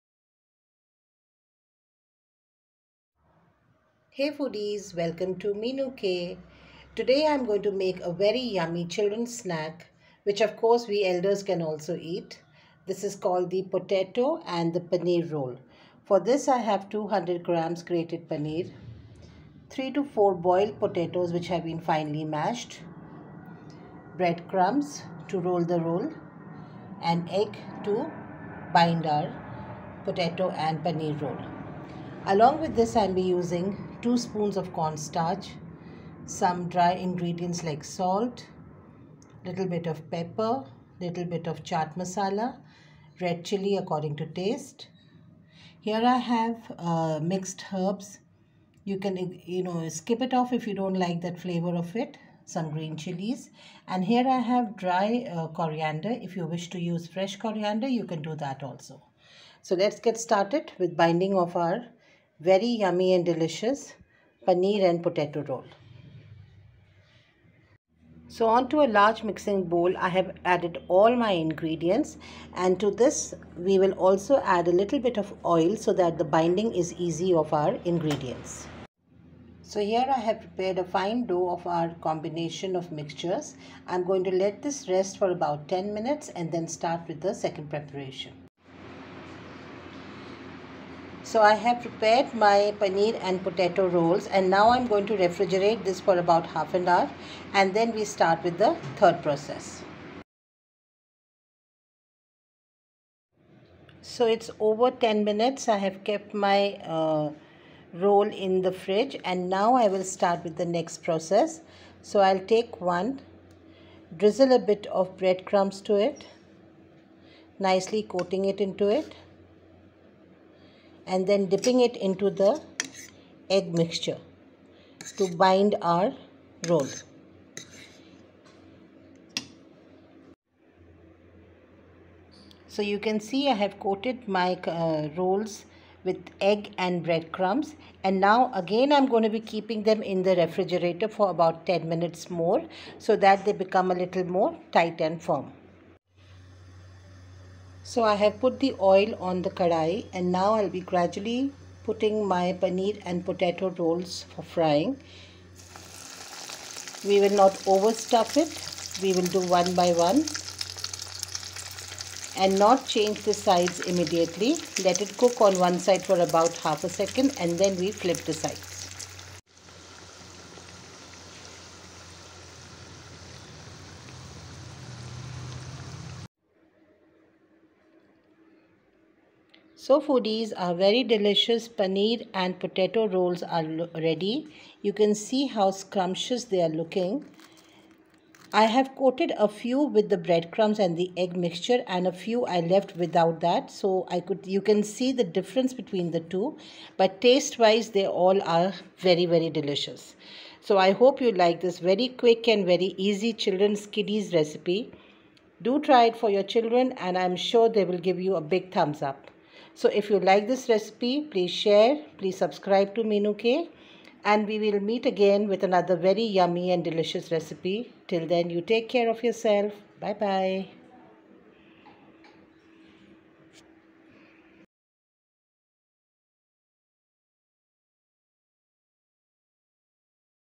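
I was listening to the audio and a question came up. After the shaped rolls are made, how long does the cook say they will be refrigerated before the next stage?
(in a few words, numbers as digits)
half an hour.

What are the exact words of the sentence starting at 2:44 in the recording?
Let it cook on one side for about half a second and then we flip the side.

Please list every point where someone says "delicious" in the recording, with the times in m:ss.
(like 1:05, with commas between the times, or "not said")
1:03, 3:01, 3:19, 3:36.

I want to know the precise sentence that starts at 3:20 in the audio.
So I hope you like this very quick and very easy children's kiddies recipe.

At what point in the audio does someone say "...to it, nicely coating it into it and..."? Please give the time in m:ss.
1:55.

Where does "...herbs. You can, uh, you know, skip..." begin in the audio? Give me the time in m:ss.
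0:47.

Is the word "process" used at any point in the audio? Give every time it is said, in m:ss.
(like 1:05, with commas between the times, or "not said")
1:39, 1:51.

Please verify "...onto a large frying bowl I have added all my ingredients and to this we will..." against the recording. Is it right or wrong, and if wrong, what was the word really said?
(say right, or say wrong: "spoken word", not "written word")
wrong: "mixing", not "frying".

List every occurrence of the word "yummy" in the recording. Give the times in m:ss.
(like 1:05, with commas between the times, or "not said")
0:08, 1:02, 3:36.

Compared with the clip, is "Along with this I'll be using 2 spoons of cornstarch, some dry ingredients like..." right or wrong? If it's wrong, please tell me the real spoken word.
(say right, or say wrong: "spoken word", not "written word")
right.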